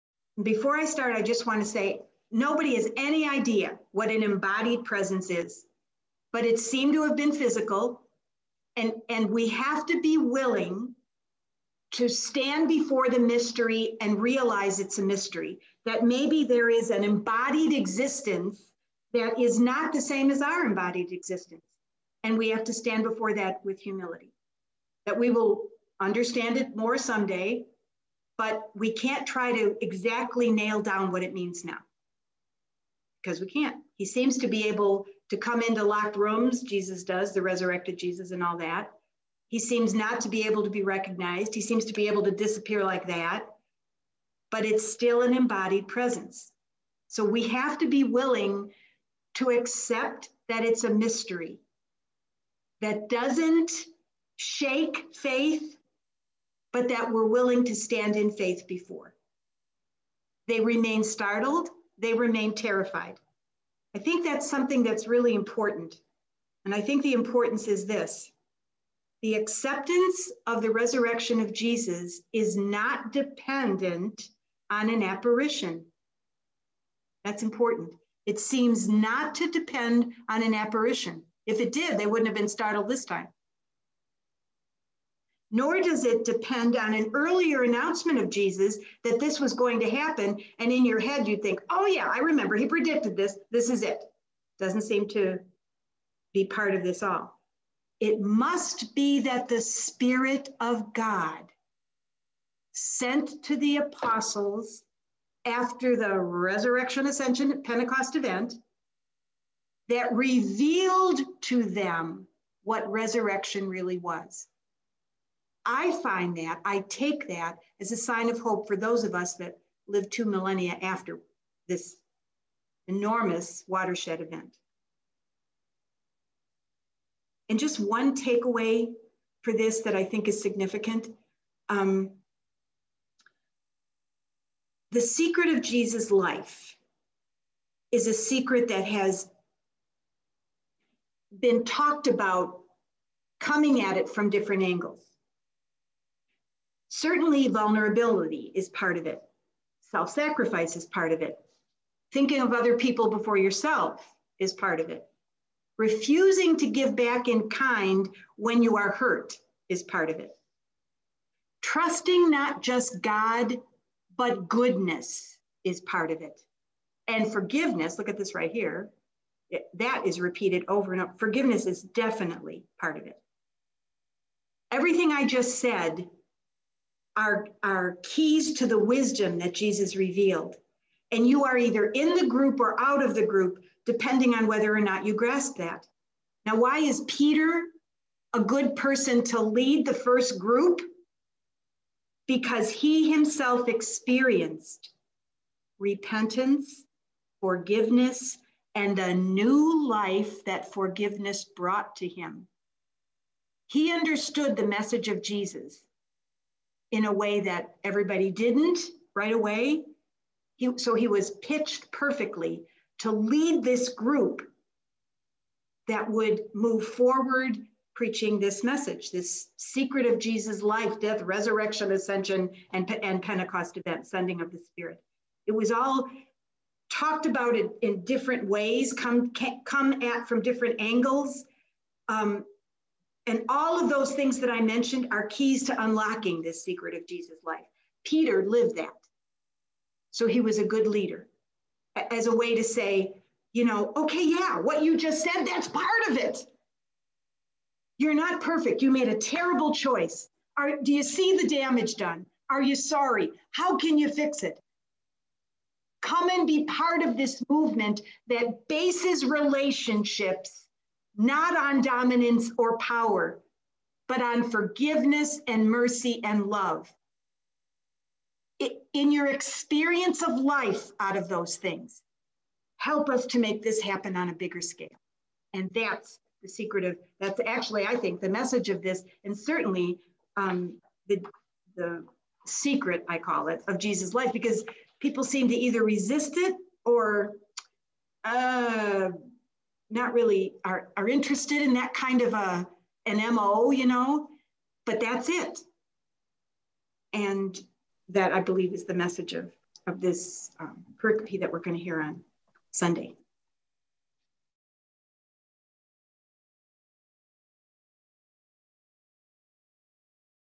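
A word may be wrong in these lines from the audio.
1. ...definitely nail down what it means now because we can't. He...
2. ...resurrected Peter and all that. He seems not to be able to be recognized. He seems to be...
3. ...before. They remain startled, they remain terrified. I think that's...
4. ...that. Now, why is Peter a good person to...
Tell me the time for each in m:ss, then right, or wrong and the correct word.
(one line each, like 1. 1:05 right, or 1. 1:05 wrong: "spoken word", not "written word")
1. 0:29 wrong: "exactly", not "definitely"
2. 0:37 wrong: "Jesus", not "Peter"
3. 0:58 right
4. 3:05 right.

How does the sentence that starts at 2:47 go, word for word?
And forgiveness, look at this right here, it, that is repeated over and over.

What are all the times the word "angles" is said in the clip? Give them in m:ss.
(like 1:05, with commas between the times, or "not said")
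2:24, 3:50.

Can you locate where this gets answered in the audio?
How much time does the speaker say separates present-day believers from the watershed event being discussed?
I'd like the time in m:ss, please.
2:00.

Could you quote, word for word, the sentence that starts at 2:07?
And just one takeaway for this that I think is significant.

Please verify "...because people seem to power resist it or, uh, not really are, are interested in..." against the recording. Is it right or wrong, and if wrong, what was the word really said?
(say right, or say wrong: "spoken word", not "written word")
wrong: "either", not "power".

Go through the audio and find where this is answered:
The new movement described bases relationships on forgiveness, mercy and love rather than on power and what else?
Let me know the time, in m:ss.
4:21.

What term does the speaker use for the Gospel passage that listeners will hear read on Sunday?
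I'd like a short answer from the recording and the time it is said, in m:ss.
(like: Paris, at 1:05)
pericope, at 5:01.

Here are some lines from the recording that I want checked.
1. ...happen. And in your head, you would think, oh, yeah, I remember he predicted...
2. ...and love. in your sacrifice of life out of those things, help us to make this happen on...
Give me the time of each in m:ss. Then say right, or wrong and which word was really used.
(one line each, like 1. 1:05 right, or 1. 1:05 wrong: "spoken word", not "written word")
1. 1:29 right
2. 4:26 wrong: "experience", not "sacrifice".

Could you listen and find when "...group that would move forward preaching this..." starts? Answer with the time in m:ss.
3:33.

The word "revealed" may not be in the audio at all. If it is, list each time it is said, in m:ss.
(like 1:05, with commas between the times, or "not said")
1:50, 2:59.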